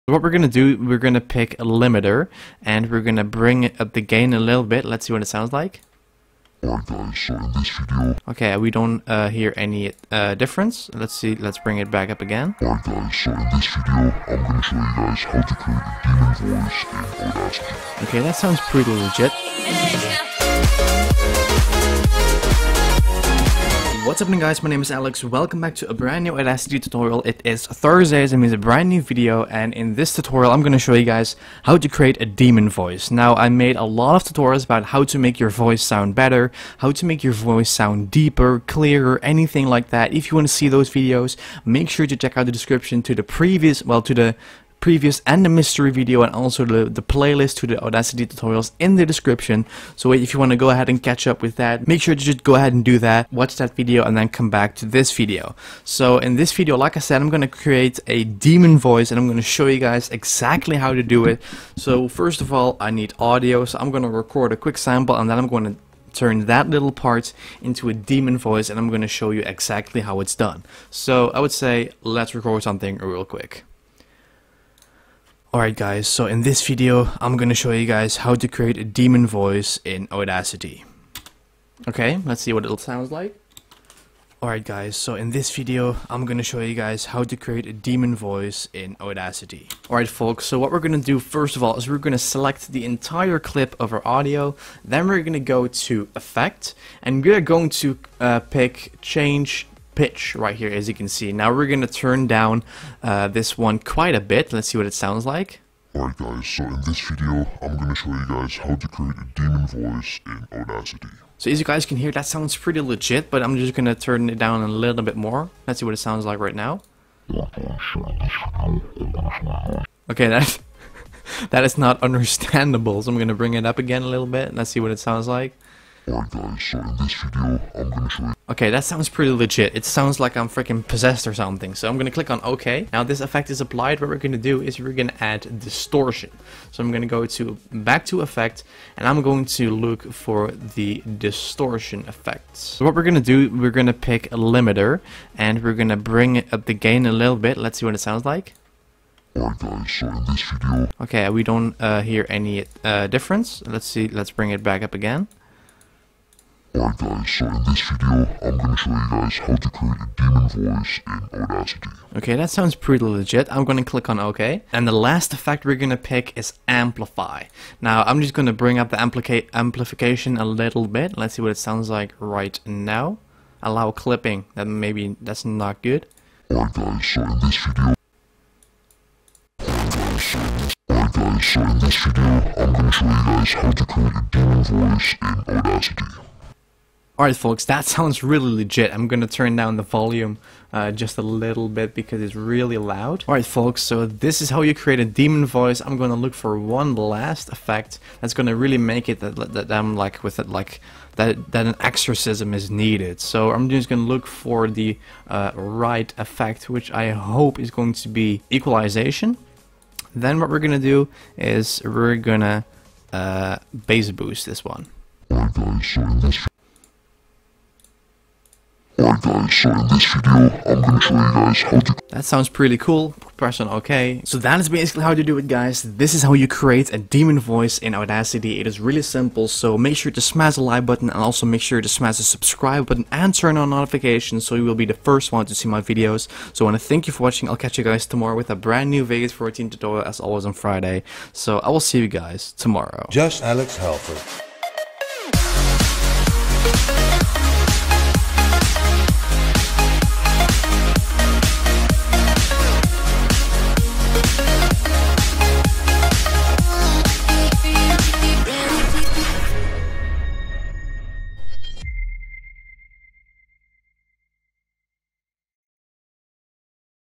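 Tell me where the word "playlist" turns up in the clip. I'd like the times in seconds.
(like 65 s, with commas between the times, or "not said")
47 s.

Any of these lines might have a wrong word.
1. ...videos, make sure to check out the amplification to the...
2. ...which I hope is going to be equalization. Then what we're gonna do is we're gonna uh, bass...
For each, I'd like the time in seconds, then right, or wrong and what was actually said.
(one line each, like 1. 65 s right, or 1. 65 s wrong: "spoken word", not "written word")
1. 40 s wrong: "description", not "amplification"
2. 206 s right.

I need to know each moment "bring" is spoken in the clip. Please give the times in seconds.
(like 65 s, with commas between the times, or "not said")
3 s, 11 s, 123 s, 145 s, 154 s, 168 s.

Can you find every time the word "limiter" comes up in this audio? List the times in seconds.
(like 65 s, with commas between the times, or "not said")
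1 s, 144 s.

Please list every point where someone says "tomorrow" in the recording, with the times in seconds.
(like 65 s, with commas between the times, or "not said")
238 s, 242 s.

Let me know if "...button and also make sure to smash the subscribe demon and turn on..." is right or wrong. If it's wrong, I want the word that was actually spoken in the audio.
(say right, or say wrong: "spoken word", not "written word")
wrong: "button", not "demon".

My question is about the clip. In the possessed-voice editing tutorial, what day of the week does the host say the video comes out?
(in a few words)
Thursday.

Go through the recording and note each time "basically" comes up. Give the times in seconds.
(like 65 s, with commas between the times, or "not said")
224 s.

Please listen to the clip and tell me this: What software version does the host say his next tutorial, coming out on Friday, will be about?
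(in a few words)
Vegas 14.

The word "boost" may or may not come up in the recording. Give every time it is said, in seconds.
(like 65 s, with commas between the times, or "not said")
214 s.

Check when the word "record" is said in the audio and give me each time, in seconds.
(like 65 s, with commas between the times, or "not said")
64 s, 72 s.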